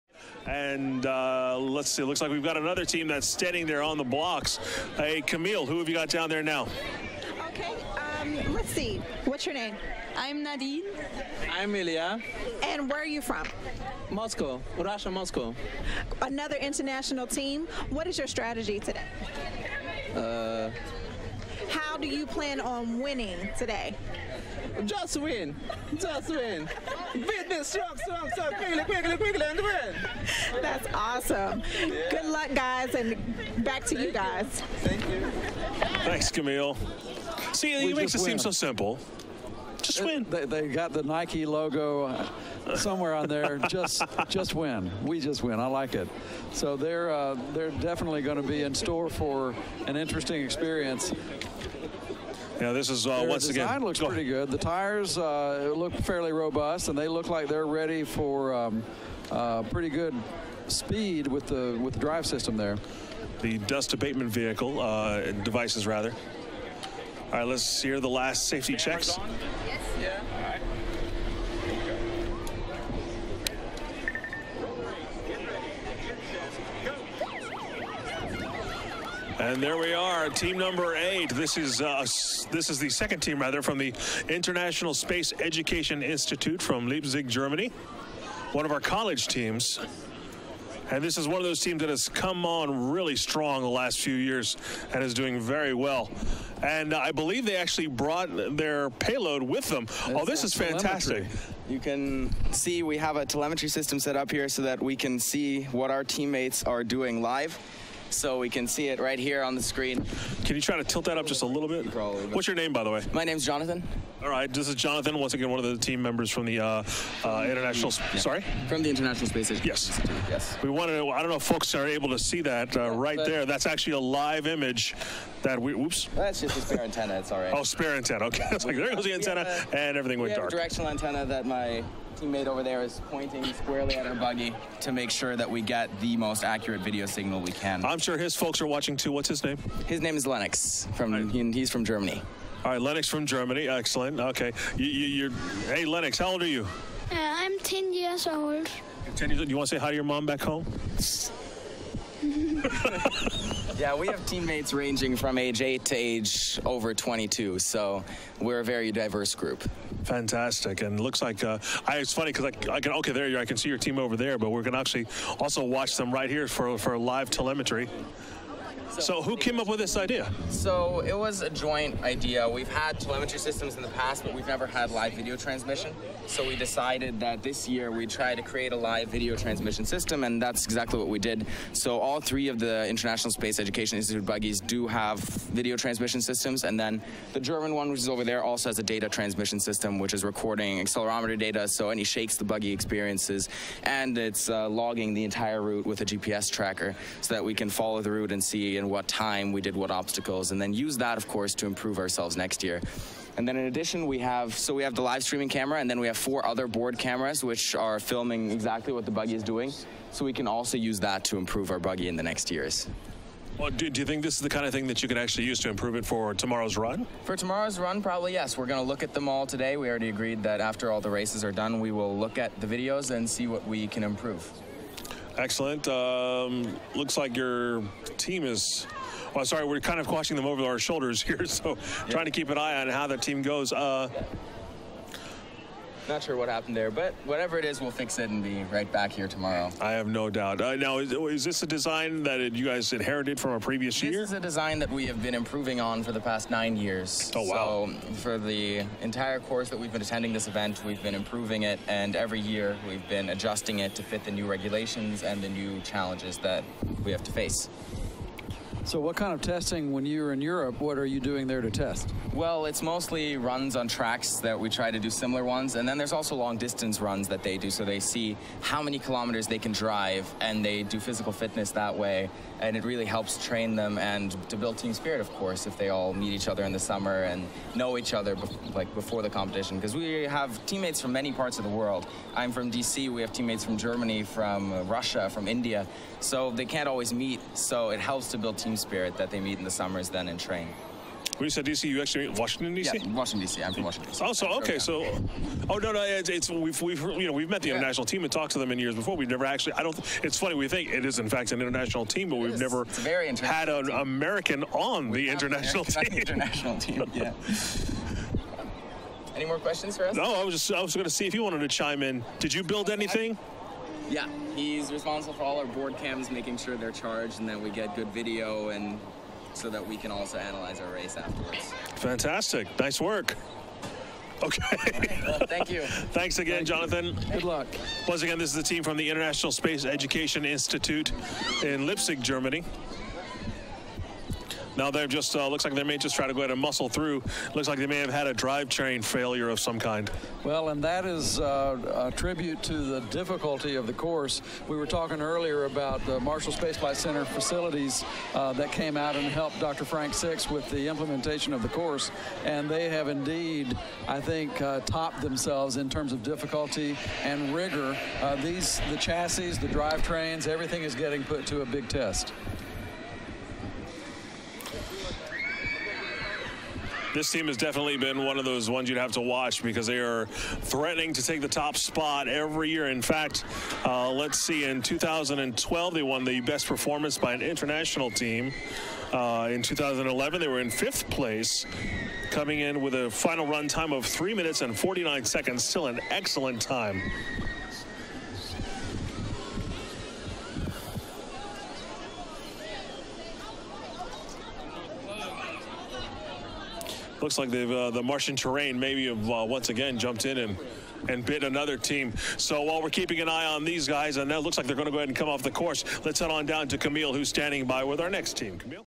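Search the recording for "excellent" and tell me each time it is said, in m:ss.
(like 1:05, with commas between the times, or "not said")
2:23, 3:45, 6:26.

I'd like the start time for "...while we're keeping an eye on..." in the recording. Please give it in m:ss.
6:42.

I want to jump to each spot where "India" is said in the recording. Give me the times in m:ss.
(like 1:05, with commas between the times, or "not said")
4:45.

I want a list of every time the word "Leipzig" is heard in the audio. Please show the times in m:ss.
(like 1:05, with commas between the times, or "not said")
1:26, 5:31.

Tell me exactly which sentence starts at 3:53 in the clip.
Uh, not sure what happened there, but whatever it is, we'll fix it and be right back here tomorrow.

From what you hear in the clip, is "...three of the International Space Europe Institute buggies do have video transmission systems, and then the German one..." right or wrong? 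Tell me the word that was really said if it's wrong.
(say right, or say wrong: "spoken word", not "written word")
wrong: "Education", not "Europe".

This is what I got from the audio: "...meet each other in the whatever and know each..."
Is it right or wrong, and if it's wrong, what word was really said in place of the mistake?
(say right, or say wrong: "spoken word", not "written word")
wrong: "summer", not "whatever".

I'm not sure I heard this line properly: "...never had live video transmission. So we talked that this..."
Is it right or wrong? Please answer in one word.
wrong.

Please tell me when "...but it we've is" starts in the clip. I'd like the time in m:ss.
5:02.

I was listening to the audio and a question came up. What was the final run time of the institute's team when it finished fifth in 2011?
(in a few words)
3 minutes 49 seconds.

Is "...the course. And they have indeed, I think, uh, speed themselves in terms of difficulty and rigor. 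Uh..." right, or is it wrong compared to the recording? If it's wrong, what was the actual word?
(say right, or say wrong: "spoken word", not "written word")
wrong: "topped", not "speed".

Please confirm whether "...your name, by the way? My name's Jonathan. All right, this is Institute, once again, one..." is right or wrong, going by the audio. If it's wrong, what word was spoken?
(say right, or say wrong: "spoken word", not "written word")
wrong: "Jonathan", not "Institute".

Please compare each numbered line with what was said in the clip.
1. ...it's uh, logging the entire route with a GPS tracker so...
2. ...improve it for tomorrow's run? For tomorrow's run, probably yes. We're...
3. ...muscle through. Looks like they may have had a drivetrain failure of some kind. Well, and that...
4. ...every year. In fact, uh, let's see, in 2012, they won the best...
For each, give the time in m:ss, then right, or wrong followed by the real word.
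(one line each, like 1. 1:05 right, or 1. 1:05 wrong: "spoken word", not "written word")
1. 3:14 right
2. 3:35 right
3. 5:36 right
4. 6:12 right.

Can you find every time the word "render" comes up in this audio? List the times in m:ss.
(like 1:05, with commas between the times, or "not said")
not said.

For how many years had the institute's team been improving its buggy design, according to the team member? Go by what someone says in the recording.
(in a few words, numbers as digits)
9.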